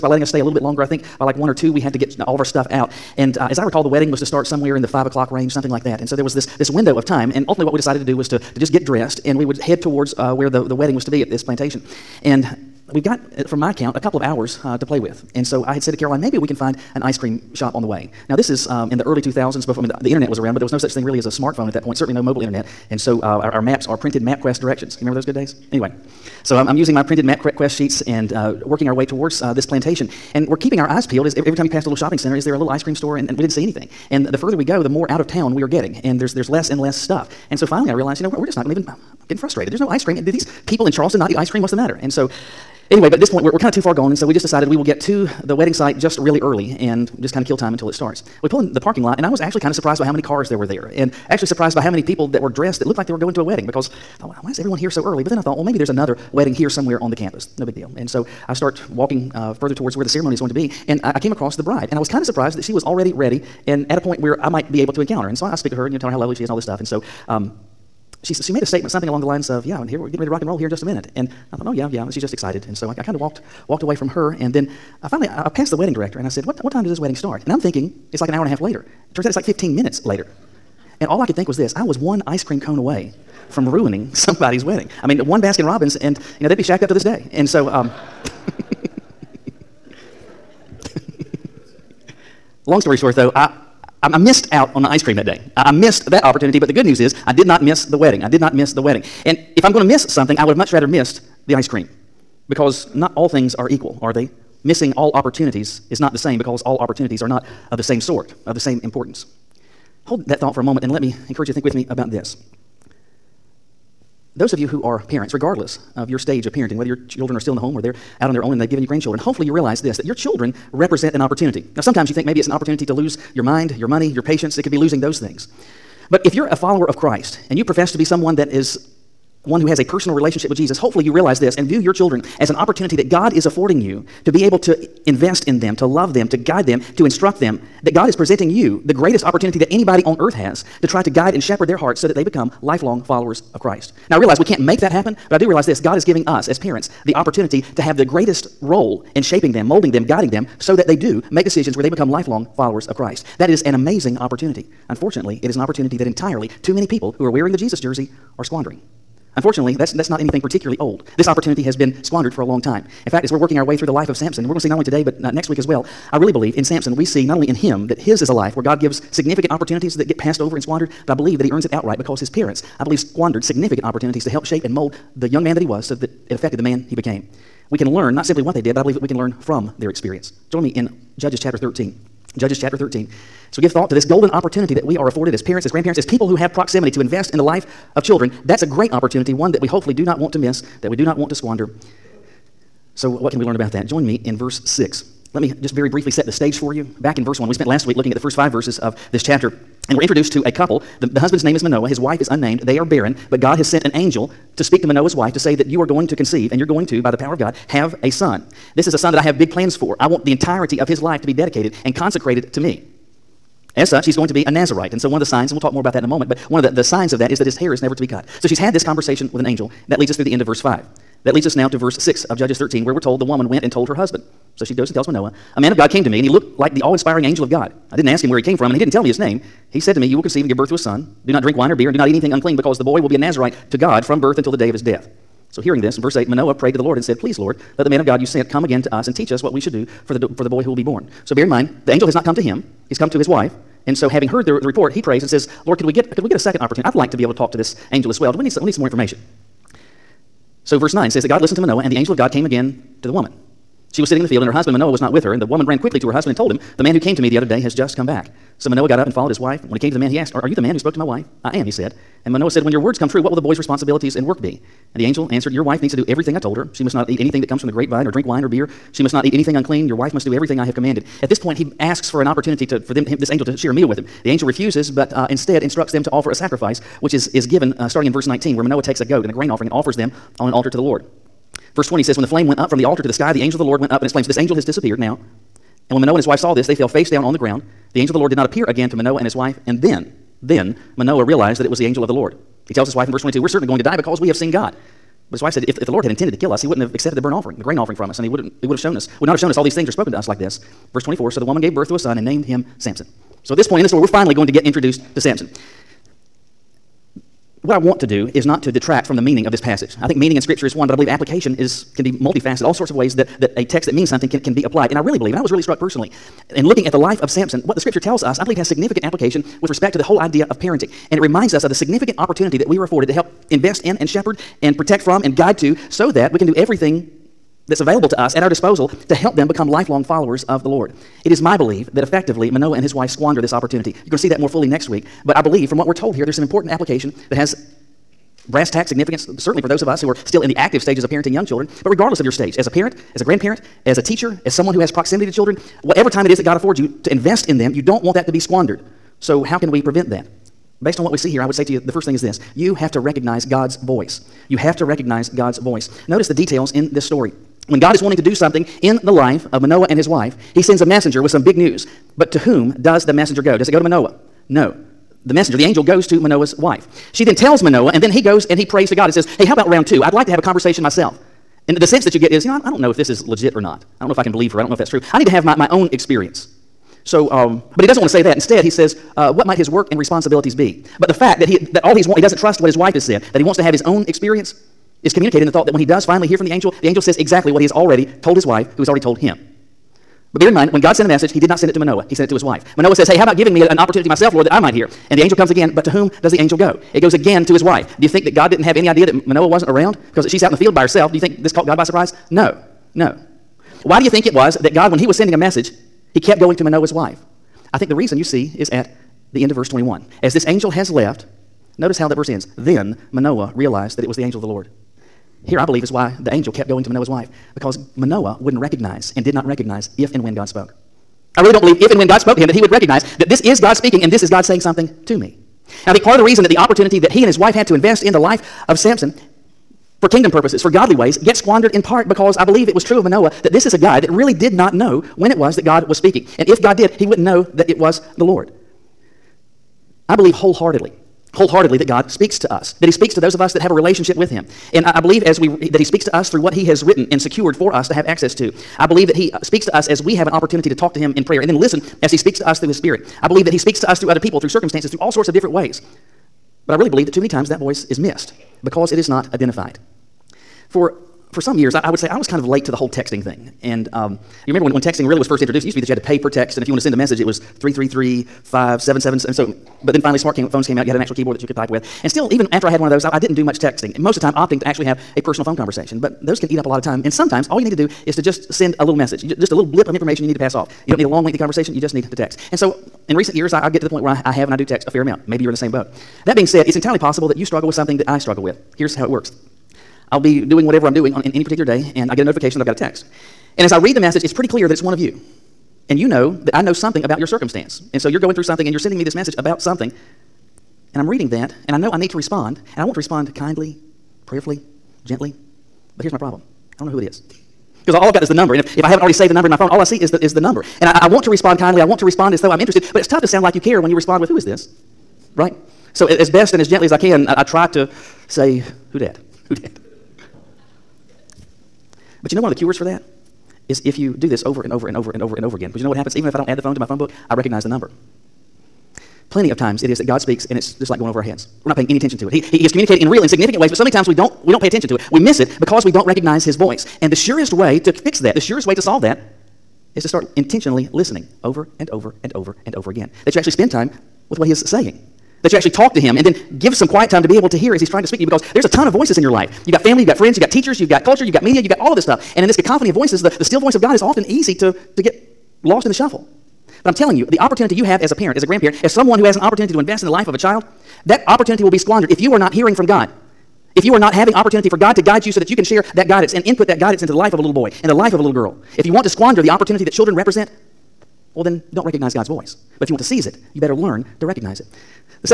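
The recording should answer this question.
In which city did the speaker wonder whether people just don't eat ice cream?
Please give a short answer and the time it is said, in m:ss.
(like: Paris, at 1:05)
Charleston, at 0:40.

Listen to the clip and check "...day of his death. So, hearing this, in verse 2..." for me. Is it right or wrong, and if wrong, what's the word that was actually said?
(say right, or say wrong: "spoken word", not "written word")
wrong: "8", not "2".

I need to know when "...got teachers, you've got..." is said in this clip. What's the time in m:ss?
9:10.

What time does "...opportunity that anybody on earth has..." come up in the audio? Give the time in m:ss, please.
2:19.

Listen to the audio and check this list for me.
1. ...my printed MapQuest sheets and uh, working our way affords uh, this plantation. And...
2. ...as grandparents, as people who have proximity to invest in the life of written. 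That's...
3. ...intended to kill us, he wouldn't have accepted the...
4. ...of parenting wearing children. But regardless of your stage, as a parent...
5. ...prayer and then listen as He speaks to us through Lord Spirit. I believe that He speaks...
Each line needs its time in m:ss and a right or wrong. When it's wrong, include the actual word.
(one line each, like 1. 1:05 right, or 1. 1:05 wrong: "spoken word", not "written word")
1. 0:26 wrong: "towards", not "affords"
2. 3:05 wrong: "children", not "written"
3. 4:56 right
4. 5:41 wrong: "young", not "wearing"
5. 7:31 wrong: "His", not "Lord".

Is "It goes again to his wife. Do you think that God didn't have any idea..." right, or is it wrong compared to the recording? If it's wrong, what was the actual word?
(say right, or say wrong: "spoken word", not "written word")
right.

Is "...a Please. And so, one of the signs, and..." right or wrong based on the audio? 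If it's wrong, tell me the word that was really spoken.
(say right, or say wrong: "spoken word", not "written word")
wrong: "Nazarite", not "Please".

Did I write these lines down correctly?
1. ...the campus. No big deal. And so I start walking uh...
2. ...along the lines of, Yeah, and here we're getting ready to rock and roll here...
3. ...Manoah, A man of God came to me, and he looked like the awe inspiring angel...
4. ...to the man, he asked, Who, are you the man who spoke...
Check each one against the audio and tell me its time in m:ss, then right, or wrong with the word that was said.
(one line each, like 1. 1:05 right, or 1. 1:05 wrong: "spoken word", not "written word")
1. 0:57 right
2. 1:09 right
3. 3:45 right
4. 4:19 wrong: "Are", not "Who".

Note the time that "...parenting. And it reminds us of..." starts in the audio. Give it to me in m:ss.
5:20.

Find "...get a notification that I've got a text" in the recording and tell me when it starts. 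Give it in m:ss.
8:12.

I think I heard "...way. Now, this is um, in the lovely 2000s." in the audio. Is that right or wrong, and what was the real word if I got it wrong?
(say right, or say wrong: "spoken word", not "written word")
wrong: "early", not "lovely".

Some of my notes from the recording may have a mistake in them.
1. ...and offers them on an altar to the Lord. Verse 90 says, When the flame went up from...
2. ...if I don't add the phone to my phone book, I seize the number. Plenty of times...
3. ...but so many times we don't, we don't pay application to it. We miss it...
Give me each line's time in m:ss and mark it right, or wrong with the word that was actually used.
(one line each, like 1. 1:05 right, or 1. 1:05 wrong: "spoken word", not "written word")
1. 4:39 wrong: "20", not "90"
2. 8:46 wrong: "recognize", not "seize"
3. 8:53 wrong: "attention", not "application".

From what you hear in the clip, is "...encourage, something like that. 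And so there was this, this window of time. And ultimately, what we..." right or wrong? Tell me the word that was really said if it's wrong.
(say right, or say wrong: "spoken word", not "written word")
wrong: "range", not "encourage".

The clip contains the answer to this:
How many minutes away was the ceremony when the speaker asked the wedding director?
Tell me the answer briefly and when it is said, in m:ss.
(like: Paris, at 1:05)
15, at 1:19.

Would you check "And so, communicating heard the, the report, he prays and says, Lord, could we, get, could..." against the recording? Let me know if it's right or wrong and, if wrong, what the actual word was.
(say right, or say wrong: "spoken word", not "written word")
wrong: "having", not "communicating".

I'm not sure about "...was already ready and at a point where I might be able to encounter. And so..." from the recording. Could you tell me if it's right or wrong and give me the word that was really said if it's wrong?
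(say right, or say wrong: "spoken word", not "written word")
right.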